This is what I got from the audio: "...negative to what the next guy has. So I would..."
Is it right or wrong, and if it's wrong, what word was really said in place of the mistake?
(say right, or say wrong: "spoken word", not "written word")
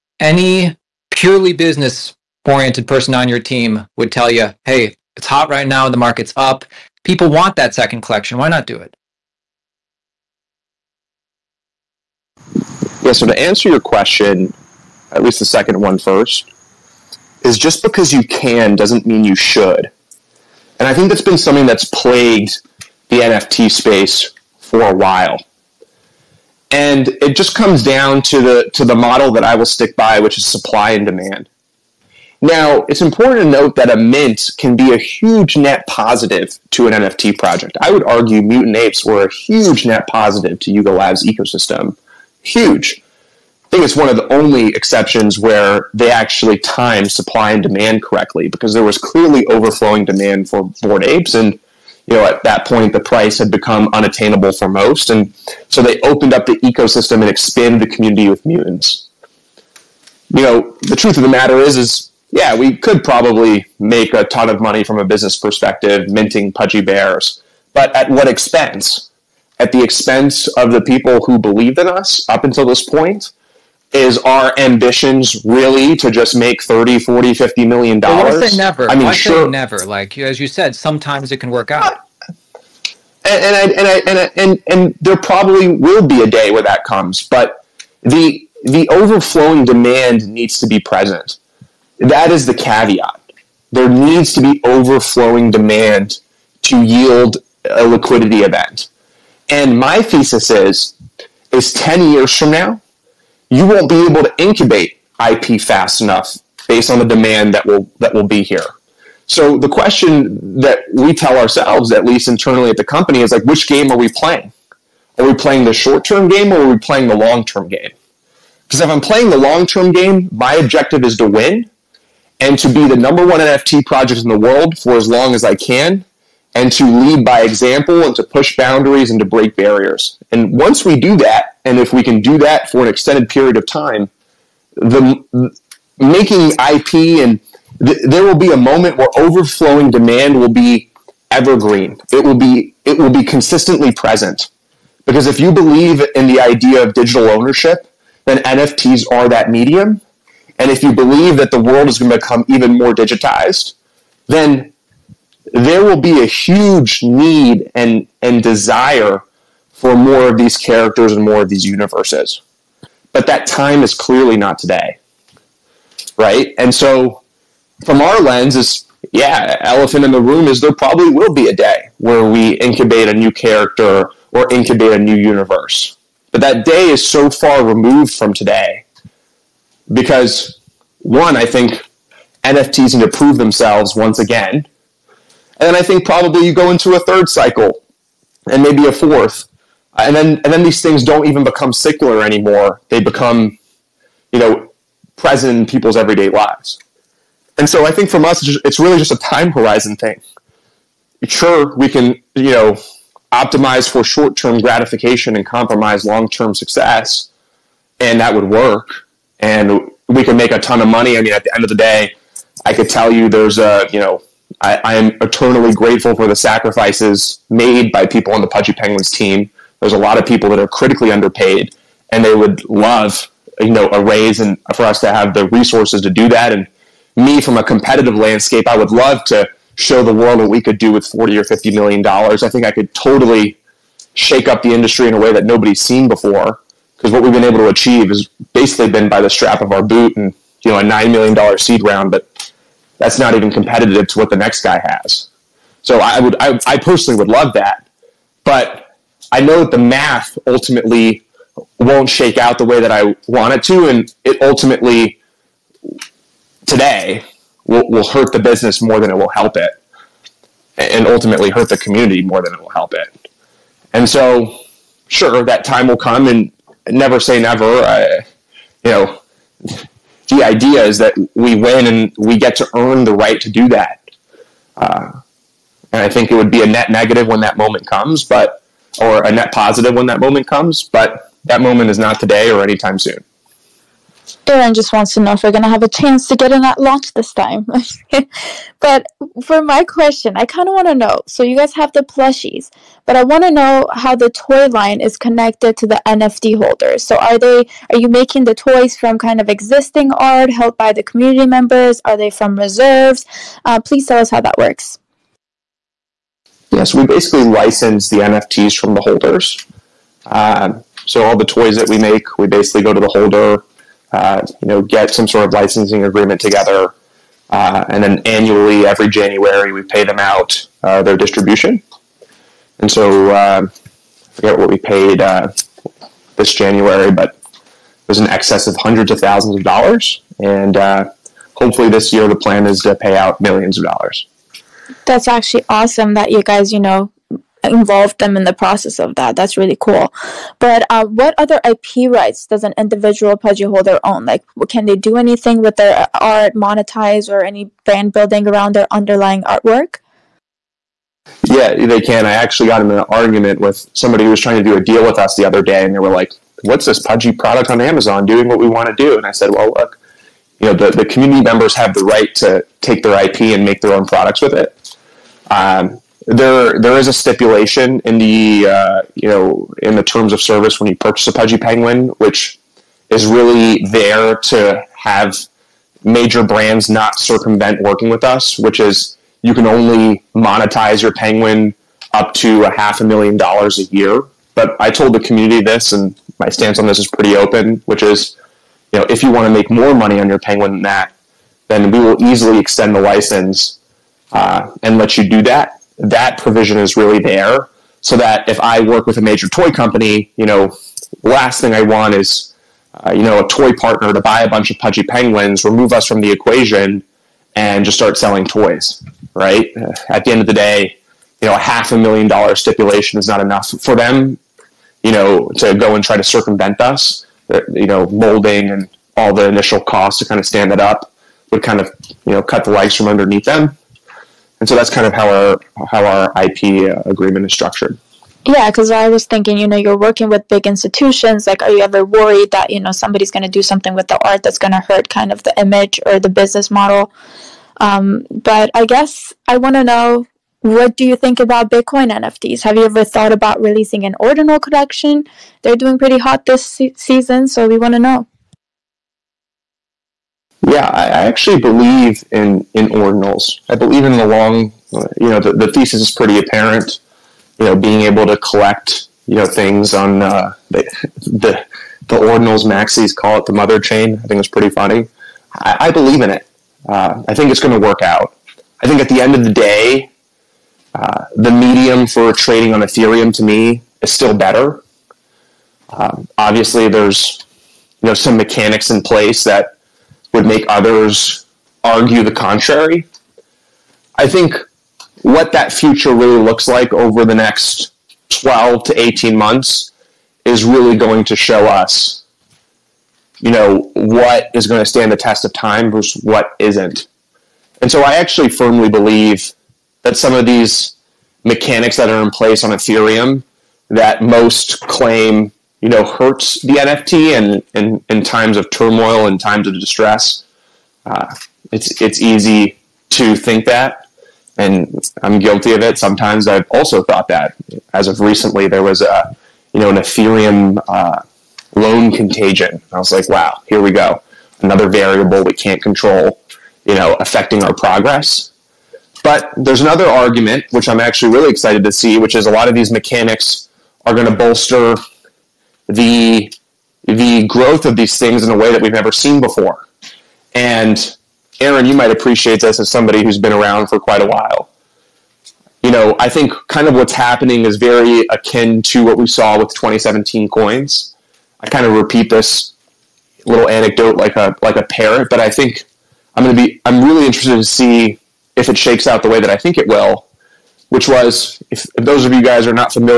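wrong: "competitive", not "negative".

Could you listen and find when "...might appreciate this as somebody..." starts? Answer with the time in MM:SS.
09:01.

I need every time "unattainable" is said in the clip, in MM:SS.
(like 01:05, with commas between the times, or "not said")
00:53.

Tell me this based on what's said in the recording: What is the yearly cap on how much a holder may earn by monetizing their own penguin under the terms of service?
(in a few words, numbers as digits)
half a million dollars.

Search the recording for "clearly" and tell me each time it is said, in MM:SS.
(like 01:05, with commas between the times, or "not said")
00:48, 02:43.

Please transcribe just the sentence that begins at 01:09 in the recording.
at the expense of the people who believed in us up until this point?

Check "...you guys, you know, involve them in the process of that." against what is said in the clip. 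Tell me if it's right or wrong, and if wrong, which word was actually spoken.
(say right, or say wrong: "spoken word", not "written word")
right.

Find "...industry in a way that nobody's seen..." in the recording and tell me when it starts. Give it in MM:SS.
03:54.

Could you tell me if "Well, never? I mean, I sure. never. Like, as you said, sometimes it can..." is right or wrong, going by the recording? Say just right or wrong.
right.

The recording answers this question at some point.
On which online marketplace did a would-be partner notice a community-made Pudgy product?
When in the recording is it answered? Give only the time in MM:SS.
05:57.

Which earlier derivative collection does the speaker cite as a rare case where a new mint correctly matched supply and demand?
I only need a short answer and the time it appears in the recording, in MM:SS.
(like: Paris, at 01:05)
Mutant Apes, at 00:38.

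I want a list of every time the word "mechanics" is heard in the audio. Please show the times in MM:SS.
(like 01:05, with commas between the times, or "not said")
07:58, 08:21, 08:52.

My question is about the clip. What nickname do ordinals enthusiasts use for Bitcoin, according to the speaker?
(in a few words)
the mother chain.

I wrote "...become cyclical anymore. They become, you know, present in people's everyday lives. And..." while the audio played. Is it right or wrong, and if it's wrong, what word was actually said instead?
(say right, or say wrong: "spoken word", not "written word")
right.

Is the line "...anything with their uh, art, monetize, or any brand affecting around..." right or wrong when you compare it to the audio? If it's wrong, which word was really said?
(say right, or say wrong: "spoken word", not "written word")
wrong: "building", not "affecting".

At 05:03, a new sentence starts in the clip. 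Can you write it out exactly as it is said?
Uh, please tell us how that works.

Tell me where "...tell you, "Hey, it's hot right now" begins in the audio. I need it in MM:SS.
00:04.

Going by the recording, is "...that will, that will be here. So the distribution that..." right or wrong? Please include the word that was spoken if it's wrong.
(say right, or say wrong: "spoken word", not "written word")
wrong: "question", not "distribution".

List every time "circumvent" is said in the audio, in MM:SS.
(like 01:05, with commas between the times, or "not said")
06:17, 06:56.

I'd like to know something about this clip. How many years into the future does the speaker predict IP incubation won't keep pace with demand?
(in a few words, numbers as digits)
10.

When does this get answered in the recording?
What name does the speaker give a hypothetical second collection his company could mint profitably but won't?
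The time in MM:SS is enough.
01:06.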